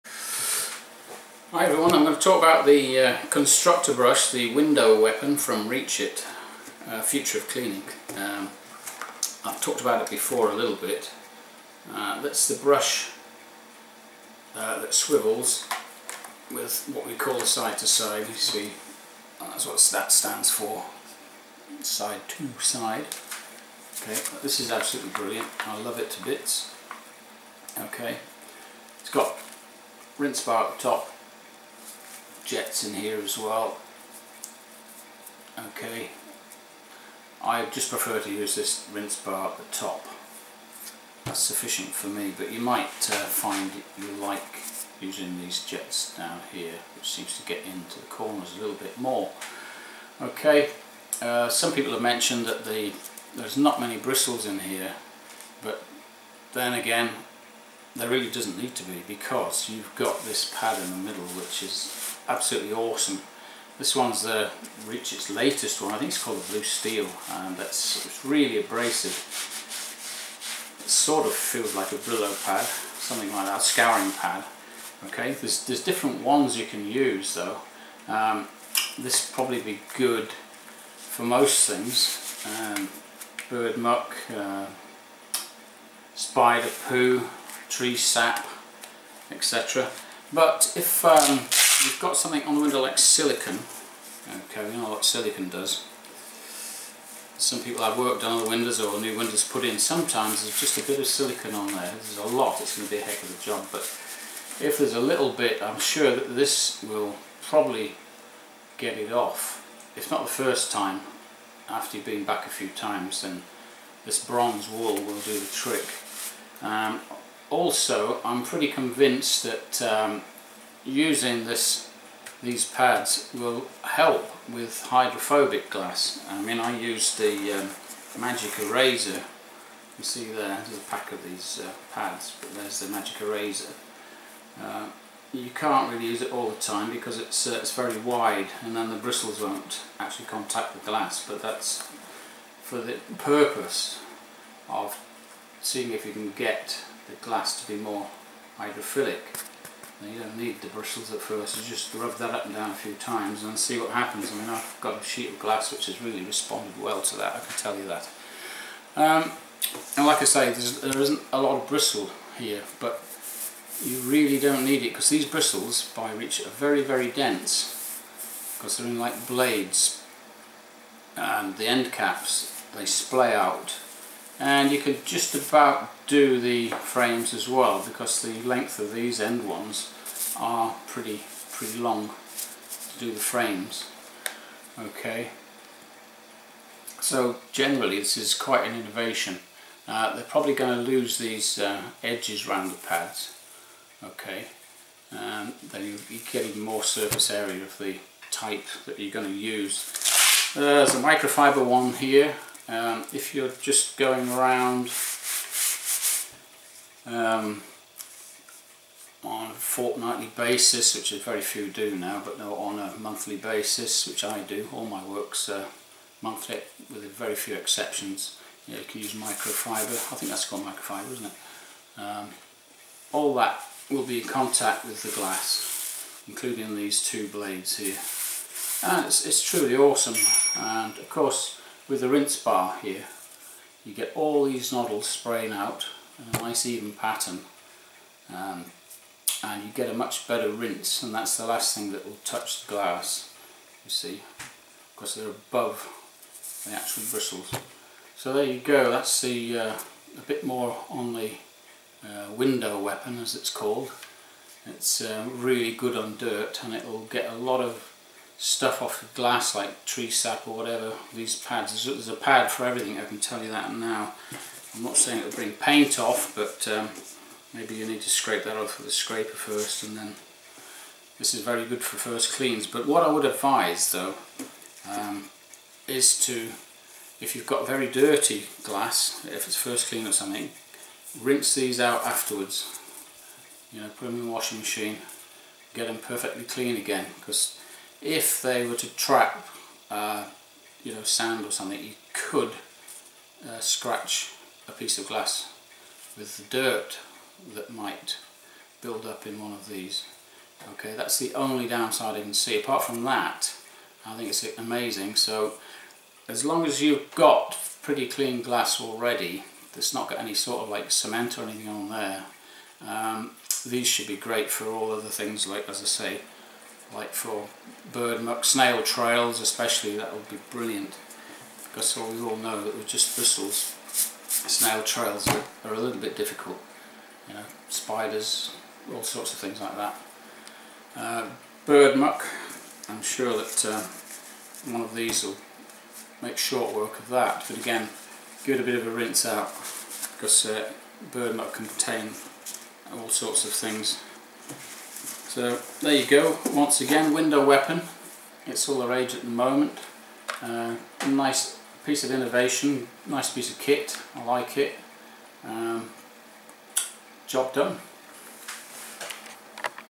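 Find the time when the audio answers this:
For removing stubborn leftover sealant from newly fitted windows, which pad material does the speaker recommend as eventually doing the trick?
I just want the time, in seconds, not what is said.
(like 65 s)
114 s.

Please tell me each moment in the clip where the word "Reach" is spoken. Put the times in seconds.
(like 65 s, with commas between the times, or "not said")
5 s, 64 s.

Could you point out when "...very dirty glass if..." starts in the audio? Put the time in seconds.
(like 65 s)
277 s.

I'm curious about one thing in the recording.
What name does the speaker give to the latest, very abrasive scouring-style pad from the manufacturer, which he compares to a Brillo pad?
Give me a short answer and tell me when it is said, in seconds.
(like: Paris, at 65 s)
Blue Steel, at 66 s.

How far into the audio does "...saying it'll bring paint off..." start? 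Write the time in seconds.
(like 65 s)
264 s.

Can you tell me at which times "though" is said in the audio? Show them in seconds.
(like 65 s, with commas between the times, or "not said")
77 s, 273 s.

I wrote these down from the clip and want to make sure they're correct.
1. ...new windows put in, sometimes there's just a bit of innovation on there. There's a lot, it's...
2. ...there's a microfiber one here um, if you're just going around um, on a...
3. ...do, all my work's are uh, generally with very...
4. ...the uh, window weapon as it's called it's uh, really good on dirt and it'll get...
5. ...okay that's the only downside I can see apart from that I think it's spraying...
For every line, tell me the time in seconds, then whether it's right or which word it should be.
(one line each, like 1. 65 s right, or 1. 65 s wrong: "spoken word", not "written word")
1. 99 s wrong: "silicon", not "innovation"
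2. 200 s right
3. 214 s wrong: "monthly", not "generally"
4. 251 s right
5. 300 s wrong: "amazing", not "spraying".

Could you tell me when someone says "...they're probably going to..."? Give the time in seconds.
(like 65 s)
190 s.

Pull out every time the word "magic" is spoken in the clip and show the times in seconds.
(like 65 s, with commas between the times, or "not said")
128 s, 132 s.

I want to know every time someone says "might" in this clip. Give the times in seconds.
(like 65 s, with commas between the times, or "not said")
42 s, 297 s.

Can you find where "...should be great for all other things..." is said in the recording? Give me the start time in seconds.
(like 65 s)
313 s.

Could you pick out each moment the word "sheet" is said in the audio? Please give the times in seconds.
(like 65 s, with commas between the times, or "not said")
155 s.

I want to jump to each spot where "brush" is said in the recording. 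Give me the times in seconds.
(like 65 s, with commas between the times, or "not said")
3 s, 12 s.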